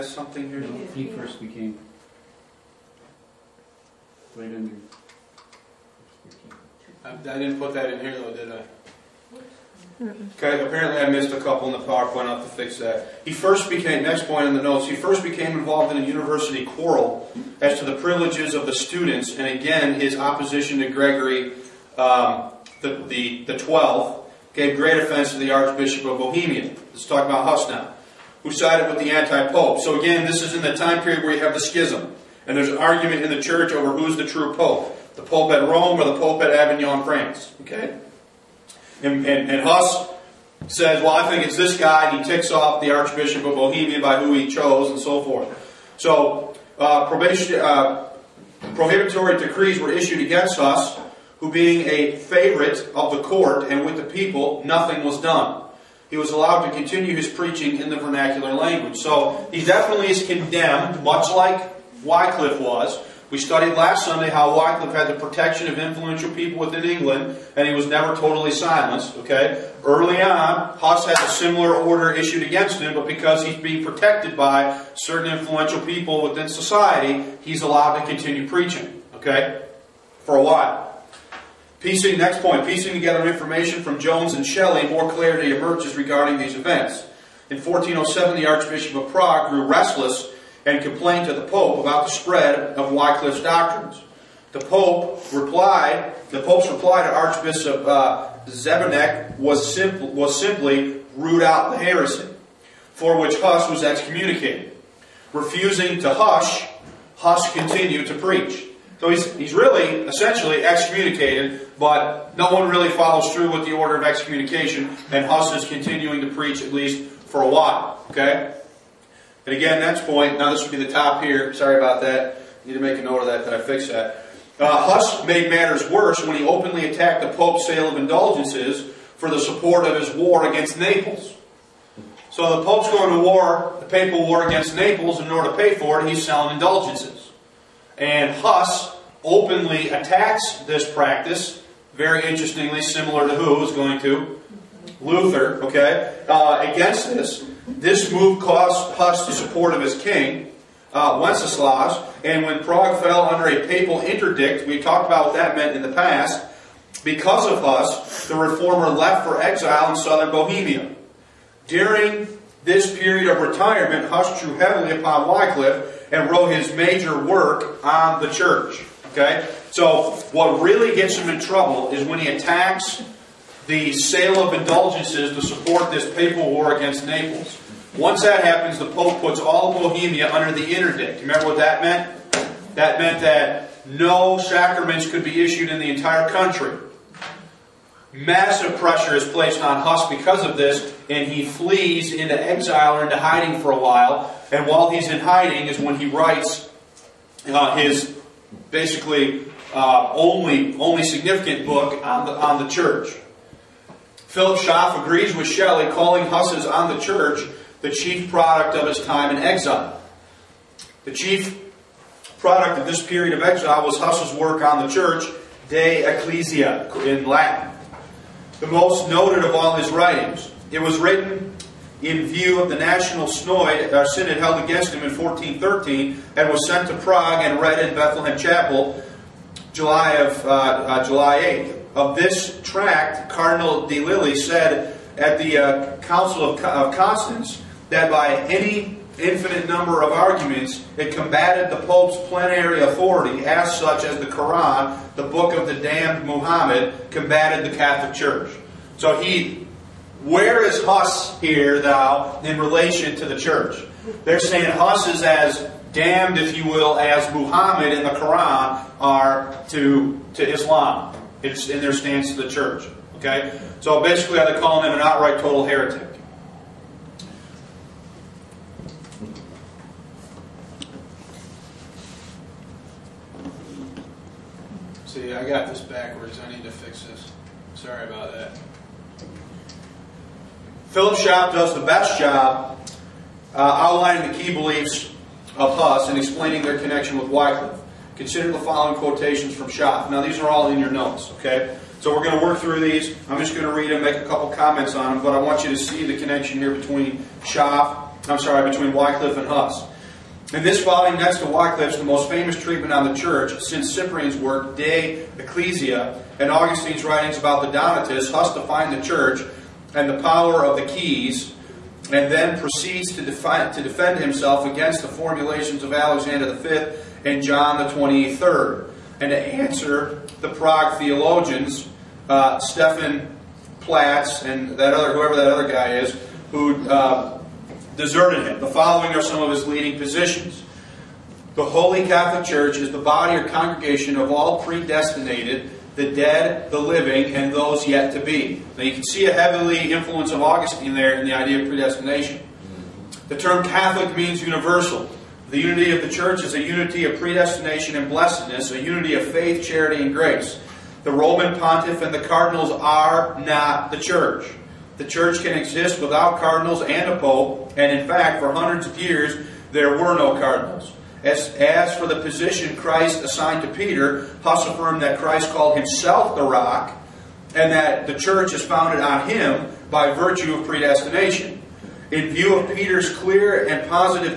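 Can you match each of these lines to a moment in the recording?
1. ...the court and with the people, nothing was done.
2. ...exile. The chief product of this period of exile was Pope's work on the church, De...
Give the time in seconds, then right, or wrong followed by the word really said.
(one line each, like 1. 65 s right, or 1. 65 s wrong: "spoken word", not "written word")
1. 53 s right
2. 209 s wrong: "Huss", not "Pope".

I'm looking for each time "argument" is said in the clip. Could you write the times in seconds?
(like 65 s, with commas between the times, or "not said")
32 s, 240 s.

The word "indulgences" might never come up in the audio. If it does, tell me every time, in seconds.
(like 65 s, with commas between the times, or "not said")
127 s, 136 s, 174 s.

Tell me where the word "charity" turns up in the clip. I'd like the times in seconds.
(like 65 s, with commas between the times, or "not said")
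349 s.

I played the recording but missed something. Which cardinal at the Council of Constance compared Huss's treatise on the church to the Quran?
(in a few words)
Cardinal de Lilly.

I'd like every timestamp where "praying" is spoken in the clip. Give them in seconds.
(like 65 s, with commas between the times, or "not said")
not said.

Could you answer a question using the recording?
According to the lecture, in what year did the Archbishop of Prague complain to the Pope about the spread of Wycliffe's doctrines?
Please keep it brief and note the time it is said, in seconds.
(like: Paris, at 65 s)
1407, at 87 s.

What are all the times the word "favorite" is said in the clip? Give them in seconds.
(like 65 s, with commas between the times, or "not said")
52 s.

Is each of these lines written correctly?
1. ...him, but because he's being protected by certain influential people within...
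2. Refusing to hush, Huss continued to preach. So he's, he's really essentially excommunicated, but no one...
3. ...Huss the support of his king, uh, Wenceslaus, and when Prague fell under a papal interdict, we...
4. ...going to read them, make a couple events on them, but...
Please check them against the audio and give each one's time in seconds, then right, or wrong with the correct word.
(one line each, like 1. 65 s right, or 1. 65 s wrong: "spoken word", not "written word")
1. 72 s right
2. 105 s right
3. 148 s right
4. 293 s wrong: "comments", not "events".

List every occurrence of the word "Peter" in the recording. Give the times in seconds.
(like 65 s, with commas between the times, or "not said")
363 s, 372 s.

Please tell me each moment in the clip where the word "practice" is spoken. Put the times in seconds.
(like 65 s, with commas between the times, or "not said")
140 s.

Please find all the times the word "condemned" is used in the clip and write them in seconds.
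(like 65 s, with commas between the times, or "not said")
60 s.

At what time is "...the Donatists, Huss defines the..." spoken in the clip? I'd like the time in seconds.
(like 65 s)
307 s.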